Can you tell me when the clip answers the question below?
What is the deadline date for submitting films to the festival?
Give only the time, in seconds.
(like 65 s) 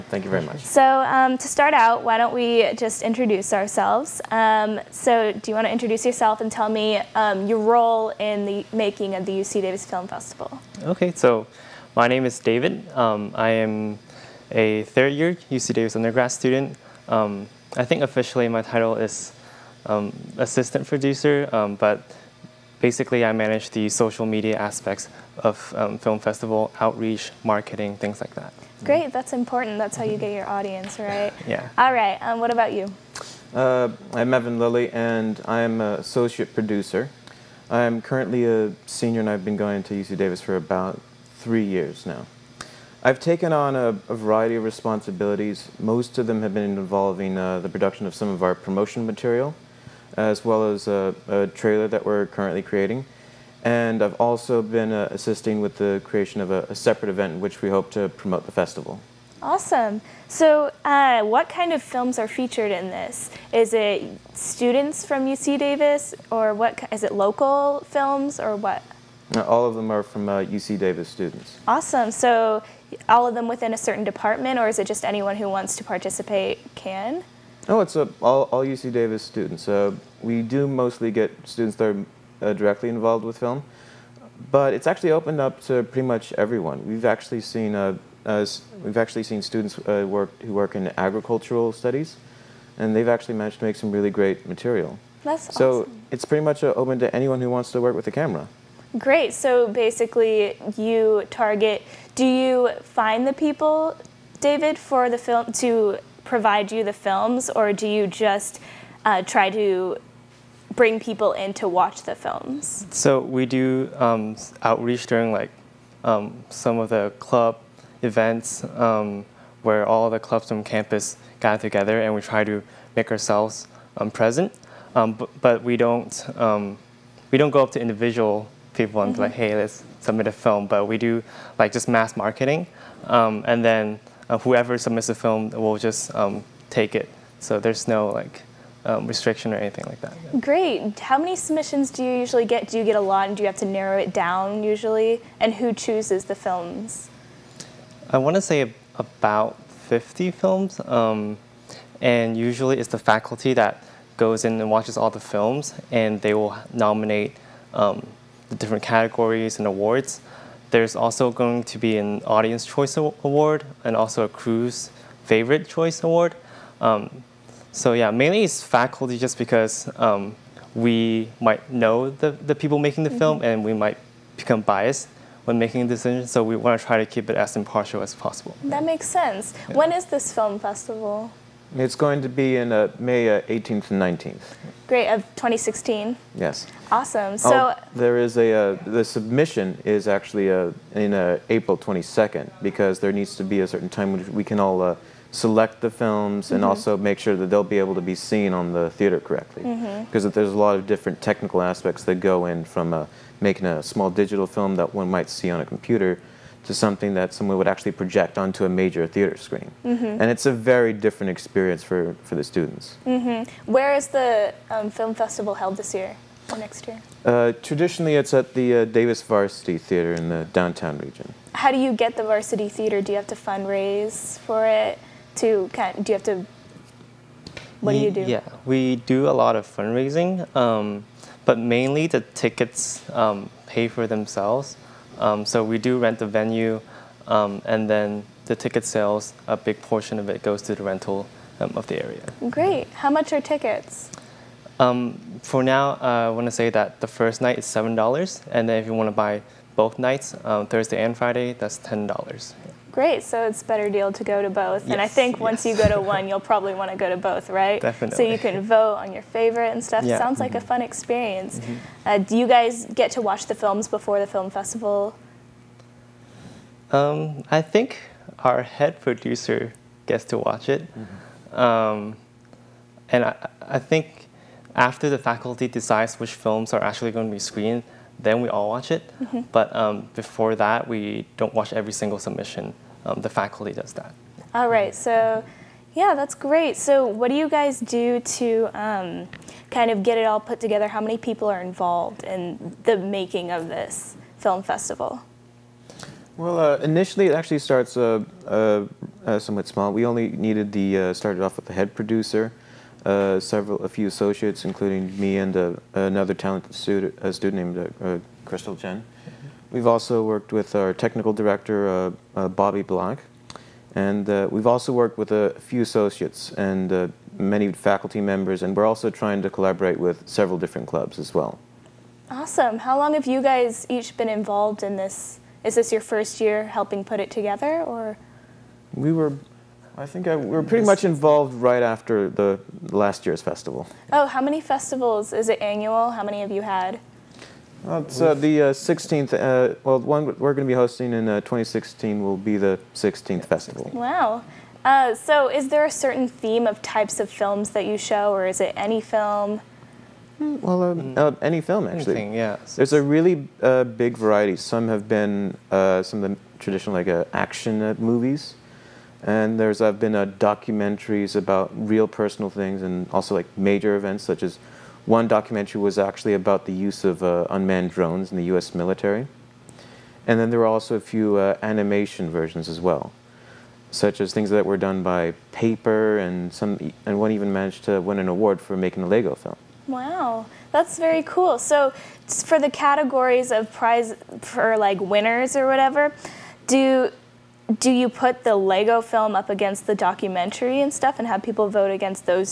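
191 s.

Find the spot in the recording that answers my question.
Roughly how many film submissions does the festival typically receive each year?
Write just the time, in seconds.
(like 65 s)
149 s.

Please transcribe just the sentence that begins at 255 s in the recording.
you go to one, you'll probably want to go to both, right?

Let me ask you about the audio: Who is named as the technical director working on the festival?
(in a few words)
Bobby Black.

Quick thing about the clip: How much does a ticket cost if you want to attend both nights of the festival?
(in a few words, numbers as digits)
$10.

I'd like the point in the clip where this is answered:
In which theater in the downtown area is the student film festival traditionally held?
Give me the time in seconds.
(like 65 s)
218 s.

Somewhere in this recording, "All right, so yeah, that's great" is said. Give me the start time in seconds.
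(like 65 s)
284 s.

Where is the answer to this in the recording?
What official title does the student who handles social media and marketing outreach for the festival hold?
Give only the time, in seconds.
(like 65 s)
20 s.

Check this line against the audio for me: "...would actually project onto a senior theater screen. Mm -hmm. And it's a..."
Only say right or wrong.
wrong.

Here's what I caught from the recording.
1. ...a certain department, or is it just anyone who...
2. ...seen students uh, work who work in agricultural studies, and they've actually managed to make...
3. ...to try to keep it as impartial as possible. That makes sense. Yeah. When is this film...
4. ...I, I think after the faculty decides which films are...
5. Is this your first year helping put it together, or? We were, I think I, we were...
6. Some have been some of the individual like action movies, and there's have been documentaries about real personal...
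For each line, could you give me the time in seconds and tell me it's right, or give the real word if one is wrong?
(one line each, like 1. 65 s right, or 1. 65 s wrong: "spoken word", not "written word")
1. 73 s right
2. 89 s right
3. 176 s right
4. 273 s right
5. 325 s right
6. 354 s wrong: "traditional", not "individual".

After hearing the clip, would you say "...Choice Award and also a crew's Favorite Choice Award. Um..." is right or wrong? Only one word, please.
right.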